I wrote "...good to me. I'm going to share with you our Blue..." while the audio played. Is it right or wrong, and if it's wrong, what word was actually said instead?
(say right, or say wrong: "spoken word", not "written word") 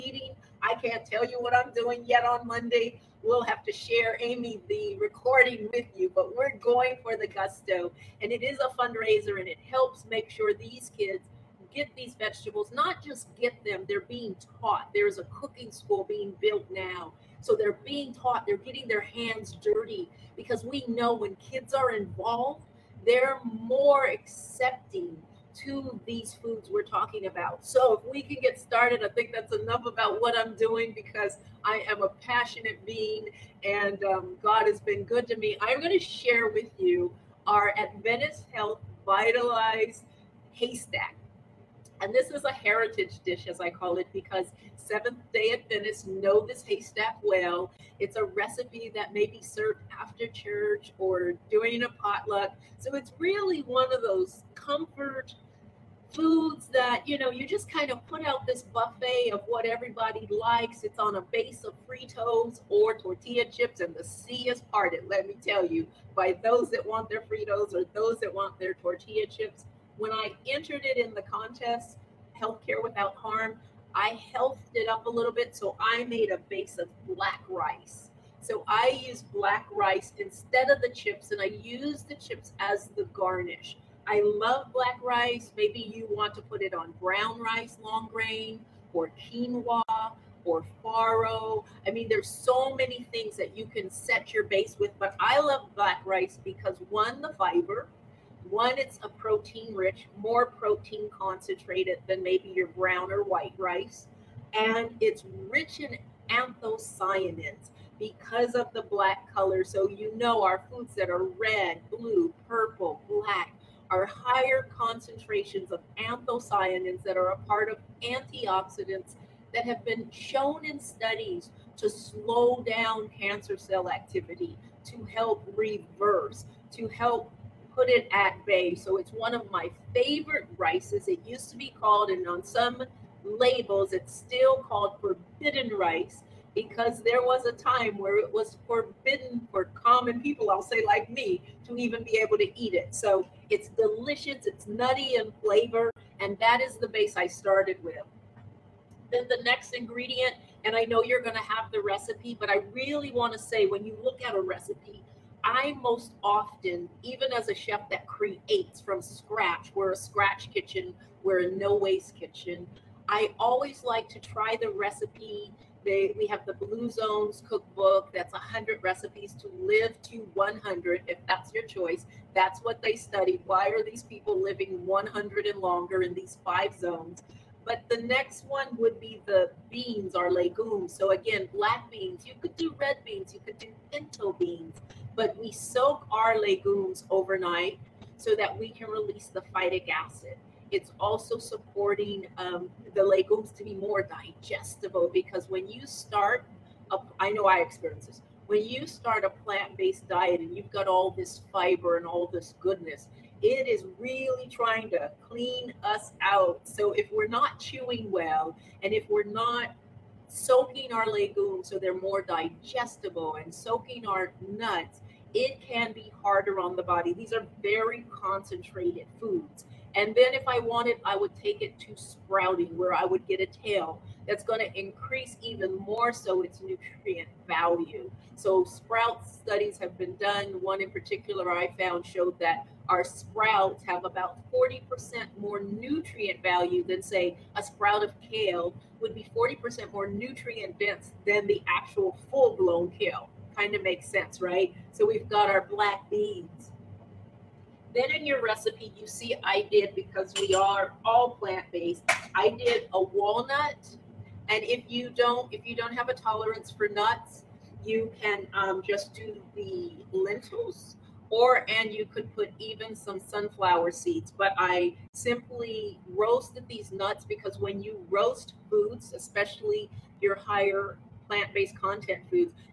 wrong: "Adventist", not "Blue".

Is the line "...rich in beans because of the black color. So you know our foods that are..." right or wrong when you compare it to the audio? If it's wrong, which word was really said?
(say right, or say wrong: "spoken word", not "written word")
wrong: "anthocyanins", not "beans".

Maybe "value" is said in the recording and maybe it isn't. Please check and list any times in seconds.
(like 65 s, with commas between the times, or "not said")
227 s, 236 s.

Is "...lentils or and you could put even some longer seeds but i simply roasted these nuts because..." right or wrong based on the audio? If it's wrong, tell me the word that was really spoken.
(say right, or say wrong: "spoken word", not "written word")
wrong: "sunflower", not "longer".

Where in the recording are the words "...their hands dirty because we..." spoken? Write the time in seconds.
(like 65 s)
18 s.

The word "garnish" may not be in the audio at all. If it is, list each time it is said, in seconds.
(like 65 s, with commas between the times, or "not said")
83 s.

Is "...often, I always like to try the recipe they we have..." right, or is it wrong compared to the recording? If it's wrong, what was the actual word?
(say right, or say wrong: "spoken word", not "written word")
wrong: "kitchen", not "often".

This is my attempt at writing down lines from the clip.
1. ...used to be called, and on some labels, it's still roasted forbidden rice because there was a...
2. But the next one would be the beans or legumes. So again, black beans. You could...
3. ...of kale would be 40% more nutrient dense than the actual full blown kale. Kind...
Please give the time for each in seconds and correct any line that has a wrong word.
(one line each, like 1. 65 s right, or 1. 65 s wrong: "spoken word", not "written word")
1. 131 s wrong: "called", not "roasted"
2. 177 s right
3. 238 s right.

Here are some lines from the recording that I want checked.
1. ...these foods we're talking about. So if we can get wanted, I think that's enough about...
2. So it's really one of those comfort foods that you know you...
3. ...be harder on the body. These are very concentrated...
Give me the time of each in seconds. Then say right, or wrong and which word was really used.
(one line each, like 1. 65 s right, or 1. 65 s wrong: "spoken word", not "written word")
1. 26 s wrong: "started", not "wanted"
2. 52 s right
3. 215 s right.